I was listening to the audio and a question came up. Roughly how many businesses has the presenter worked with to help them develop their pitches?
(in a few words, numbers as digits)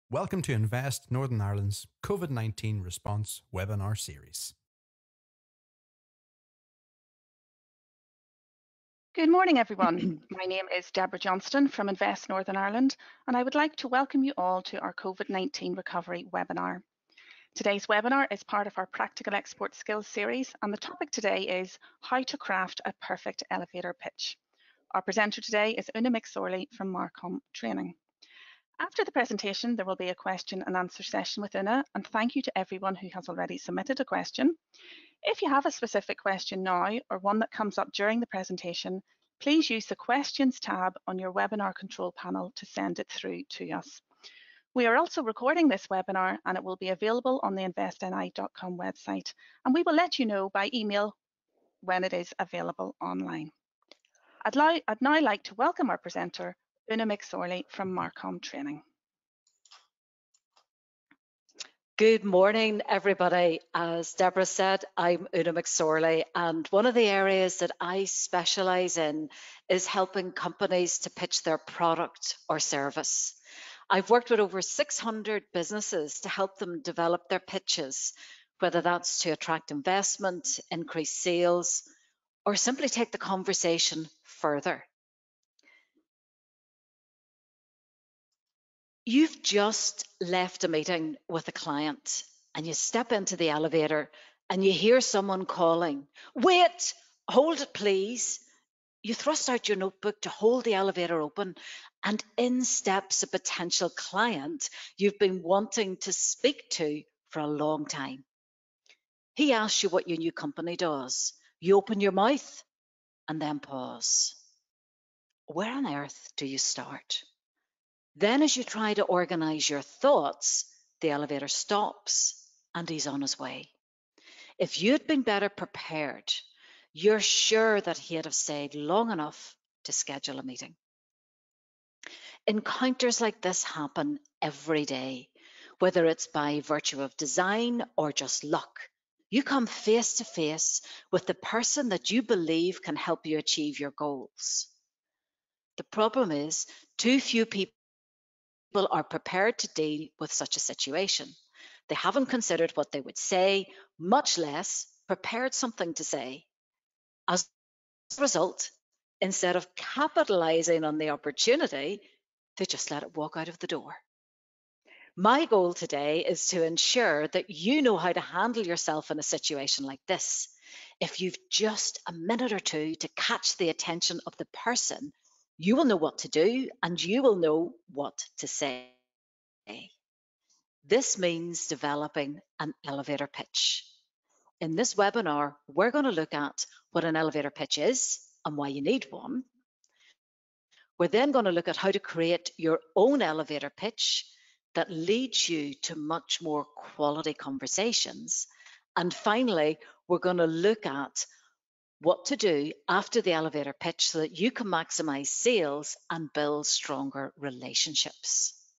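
600.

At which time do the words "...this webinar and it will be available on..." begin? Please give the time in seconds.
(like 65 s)
45 s.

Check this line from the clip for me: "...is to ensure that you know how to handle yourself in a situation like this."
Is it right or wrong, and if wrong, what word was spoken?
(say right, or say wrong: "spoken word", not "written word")
right.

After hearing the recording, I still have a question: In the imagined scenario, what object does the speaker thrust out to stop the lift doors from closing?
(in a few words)
notebook.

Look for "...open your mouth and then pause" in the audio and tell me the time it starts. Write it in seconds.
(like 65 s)
111 s.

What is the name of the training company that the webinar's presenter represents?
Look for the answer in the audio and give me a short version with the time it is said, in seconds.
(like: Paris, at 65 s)
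Marcom Training, at 26 s.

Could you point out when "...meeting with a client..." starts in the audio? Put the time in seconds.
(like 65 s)
90 s.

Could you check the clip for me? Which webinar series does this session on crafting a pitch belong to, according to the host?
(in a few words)
Practical Export Skills.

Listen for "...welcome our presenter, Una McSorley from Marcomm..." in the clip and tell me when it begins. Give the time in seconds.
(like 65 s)
55 s.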